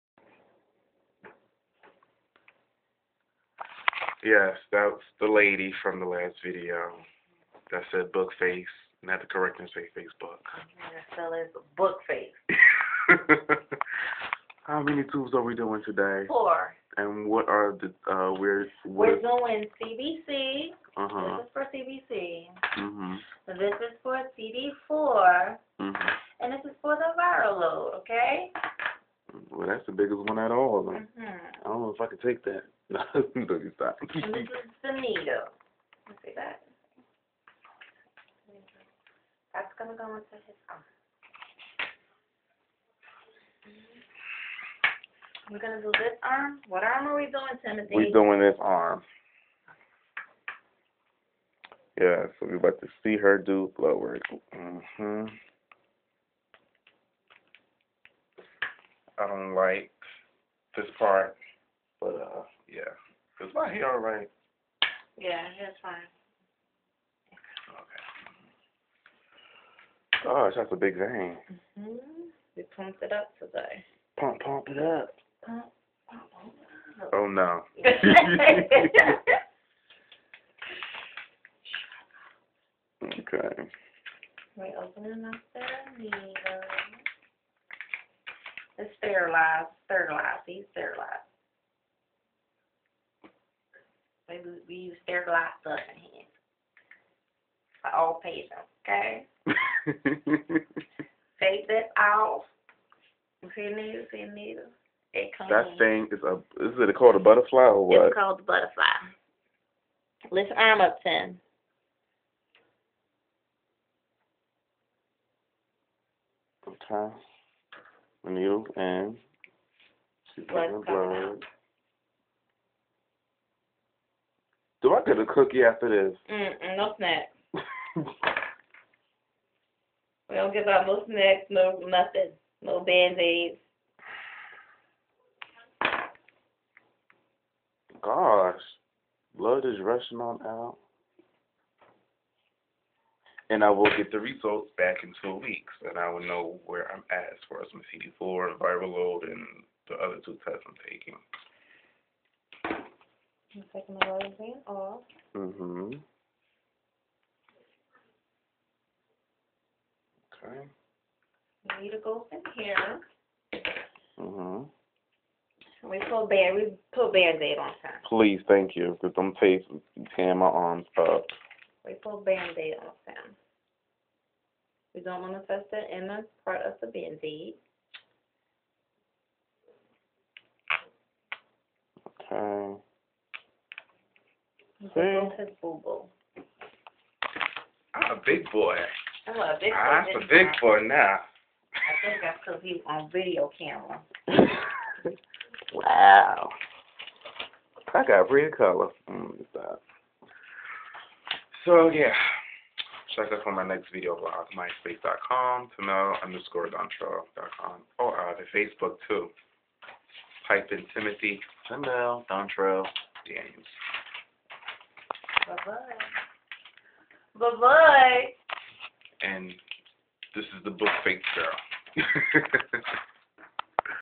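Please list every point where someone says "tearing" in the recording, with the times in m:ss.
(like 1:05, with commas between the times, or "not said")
2:50.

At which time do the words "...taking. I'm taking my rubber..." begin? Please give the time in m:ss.
2:30.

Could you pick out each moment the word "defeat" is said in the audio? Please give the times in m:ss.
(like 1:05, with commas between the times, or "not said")
not said.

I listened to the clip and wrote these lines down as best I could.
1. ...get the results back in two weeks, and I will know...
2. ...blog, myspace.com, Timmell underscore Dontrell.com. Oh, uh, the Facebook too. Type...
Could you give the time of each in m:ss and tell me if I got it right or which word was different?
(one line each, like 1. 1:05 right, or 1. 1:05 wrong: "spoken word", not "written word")
1. 2:23 right
2. 3:24 right.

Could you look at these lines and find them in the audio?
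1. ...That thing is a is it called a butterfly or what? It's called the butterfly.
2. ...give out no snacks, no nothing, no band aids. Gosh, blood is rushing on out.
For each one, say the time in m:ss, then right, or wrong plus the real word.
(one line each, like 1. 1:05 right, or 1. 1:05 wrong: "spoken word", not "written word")
1. 1:45 right
2. 2:10 right.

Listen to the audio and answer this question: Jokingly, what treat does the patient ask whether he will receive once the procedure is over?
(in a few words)
a cookie.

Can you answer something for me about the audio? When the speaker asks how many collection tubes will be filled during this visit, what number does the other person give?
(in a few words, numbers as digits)
4.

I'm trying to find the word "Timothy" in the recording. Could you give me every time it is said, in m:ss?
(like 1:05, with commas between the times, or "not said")
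0:47, 3:30.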